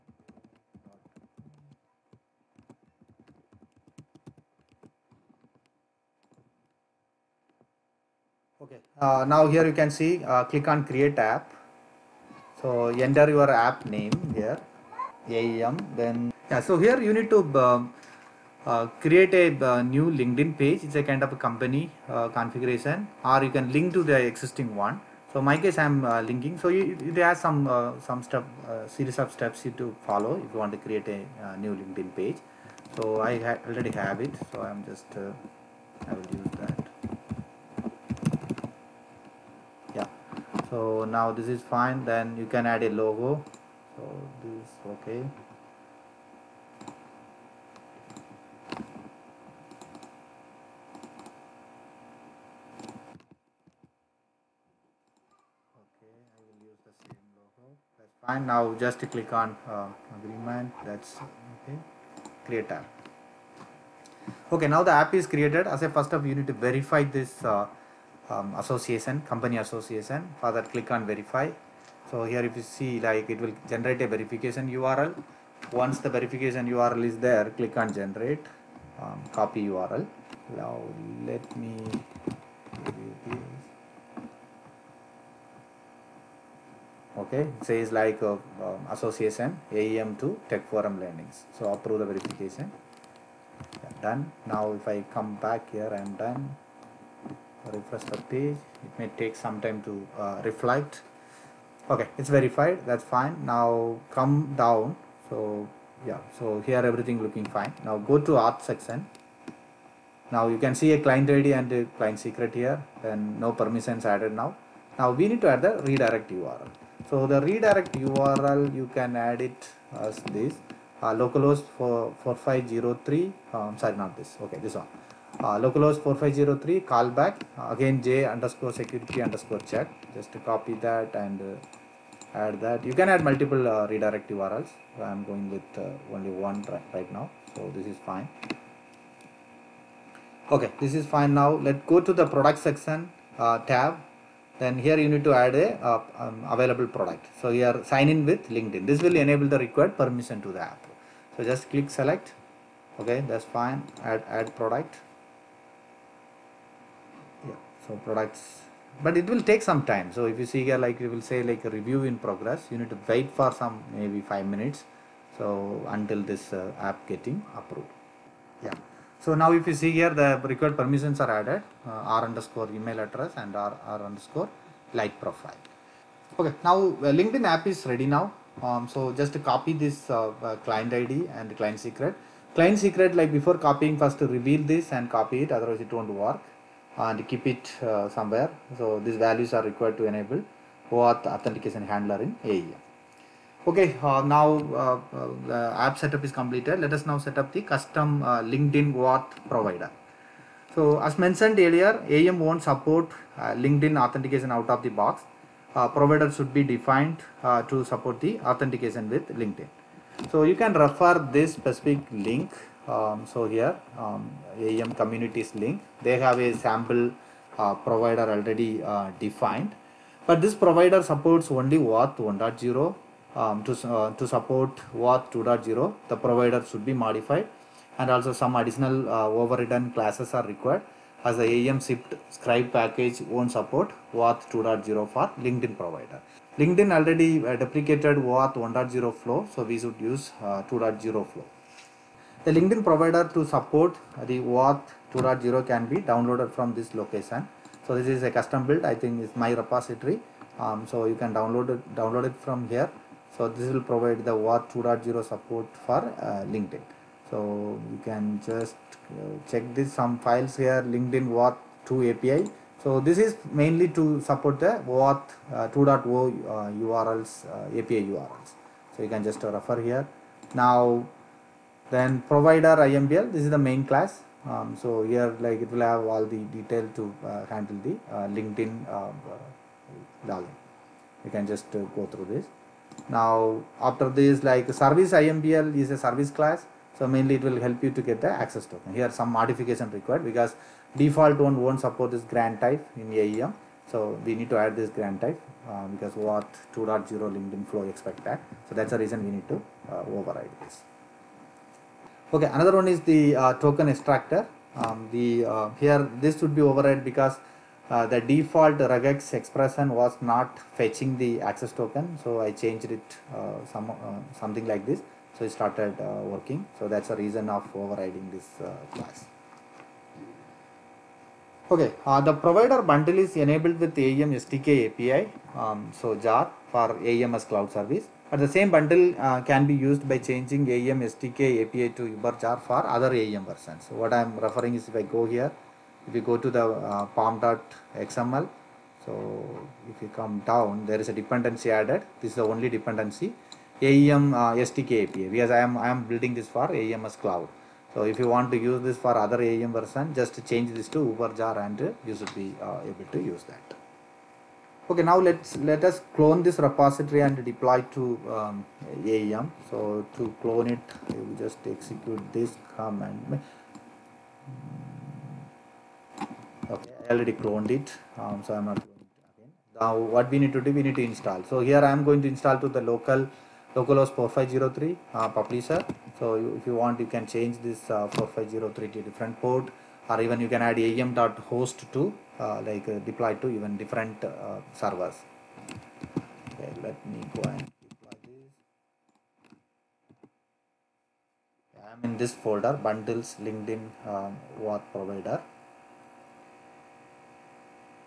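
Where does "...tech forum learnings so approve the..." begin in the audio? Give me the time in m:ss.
1:30.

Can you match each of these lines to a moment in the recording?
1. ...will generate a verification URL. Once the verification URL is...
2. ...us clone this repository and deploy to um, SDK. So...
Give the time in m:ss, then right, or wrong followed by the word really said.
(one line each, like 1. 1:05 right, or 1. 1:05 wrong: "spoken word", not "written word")
1. 1:13 right
2. 5:55 wrong: "AEM", not "SDK".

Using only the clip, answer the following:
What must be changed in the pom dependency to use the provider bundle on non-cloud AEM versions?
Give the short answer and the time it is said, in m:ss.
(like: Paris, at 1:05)
Uber JAR, at 5:51.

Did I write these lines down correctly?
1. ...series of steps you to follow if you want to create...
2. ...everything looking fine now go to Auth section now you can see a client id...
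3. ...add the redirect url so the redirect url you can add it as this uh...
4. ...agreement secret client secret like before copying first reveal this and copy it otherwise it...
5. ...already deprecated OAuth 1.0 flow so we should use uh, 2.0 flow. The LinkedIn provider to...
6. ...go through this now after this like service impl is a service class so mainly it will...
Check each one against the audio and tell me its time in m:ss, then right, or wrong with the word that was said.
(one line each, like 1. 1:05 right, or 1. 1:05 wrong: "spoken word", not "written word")
1. 0:28 right
2. 1:46 right
3. 1:55 right
4. 3:01 wrong: "client", not "agreement"
5. 3:56 right
6. 4:41 right.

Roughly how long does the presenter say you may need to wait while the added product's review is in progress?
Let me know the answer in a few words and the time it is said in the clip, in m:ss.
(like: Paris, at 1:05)
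5 minutes, at 2:44.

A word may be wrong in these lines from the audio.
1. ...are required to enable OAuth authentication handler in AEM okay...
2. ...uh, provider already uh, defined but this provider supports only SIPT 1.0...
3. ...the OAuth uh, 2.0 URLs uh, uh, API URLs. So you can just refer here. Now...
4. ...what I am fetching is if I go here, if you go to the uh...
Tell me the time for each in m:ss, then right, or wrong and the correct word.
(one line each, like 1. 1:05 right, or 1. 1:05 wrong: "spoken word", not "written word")
1. 3:09 right
2. 3:37 wrong: "OAuth", not "SIPT"
3. 4:24 right
4. 5:33 wrong: "referring", not "fetching".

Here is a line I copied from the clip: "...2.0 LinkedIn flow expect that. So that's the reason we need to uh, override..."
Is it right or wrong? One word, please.
right.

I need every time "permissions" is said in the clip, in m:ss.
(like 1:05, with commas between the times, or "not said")
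1:53, 2:30, 2:50.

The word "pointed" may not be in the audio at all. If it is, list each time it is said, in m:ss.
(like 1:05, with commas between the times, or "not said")
not said.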